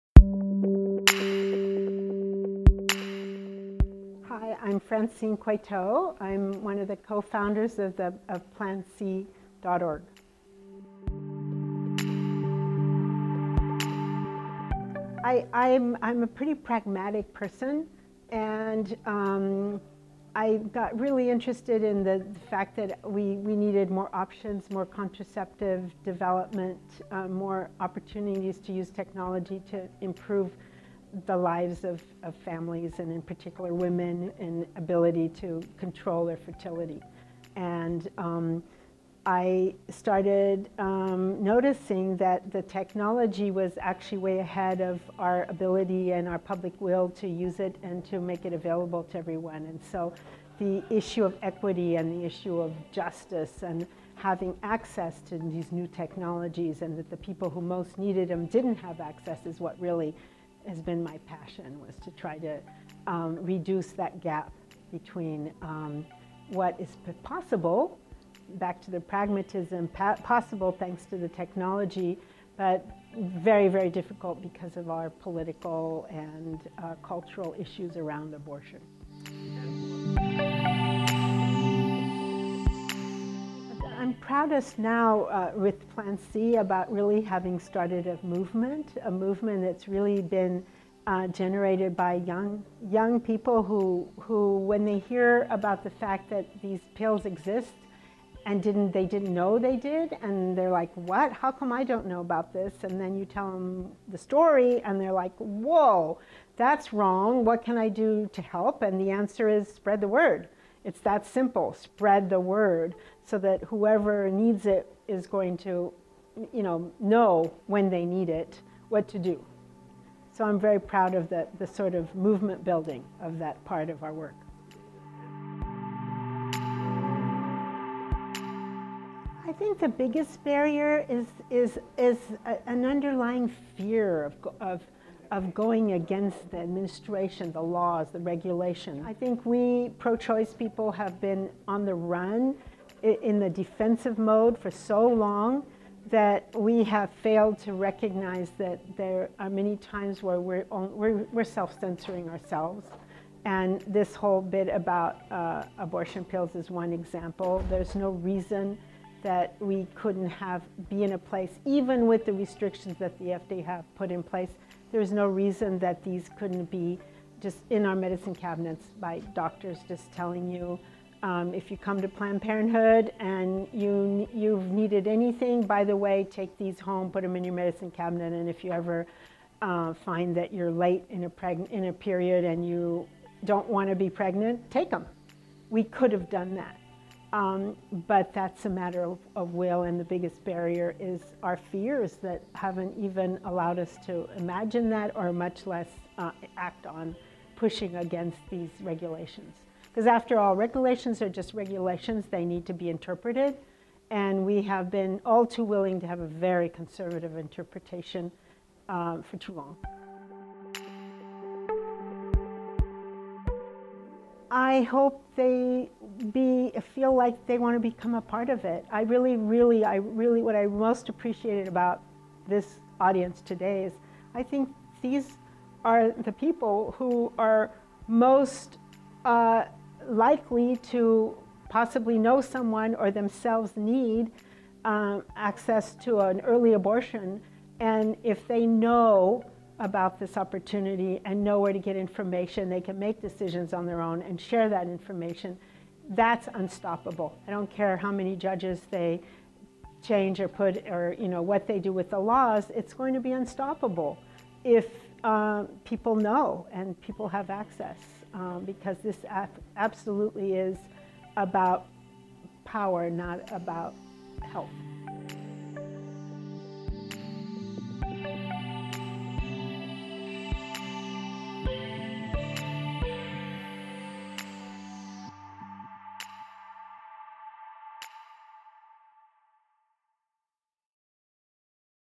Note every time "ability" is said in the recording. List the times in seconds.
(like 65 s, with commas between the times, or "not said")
34 s, 45 s.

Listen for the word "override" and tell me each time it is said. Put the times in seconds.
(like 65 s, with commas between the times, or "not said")
not said.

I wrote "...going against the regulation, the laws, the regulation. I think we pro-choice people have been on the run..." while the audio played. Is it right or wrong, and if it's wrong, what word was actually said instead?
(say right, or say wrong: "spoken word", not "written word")
wrong: "administration", not "regulation".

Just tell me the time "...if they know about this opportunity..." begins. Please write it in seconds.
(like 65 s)
238 s.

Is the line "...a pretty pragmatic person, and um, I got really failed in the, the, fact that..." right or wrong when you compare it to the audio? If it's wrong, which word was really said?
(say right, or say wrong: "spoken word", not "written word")
wrong: "interested", not "failed".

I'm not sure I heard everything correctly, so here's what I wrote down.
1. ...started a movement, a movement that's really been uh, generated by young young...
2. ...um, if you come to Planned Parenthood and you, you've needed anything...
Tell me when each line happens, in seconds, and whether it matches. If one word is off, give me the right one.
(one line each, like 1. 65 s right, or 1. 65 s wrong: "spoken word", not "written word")
1. 87 s right
2. 171 s right.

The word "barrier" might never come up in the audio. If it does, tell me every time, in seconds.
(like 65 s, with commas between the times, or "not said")
130 s, 190 s.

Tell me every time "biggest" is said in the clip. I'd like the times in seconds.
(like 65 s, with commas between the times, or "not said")
129 s, 190 s.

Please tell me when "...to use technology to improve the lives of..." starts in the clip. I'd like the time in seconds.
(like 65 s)
28 s.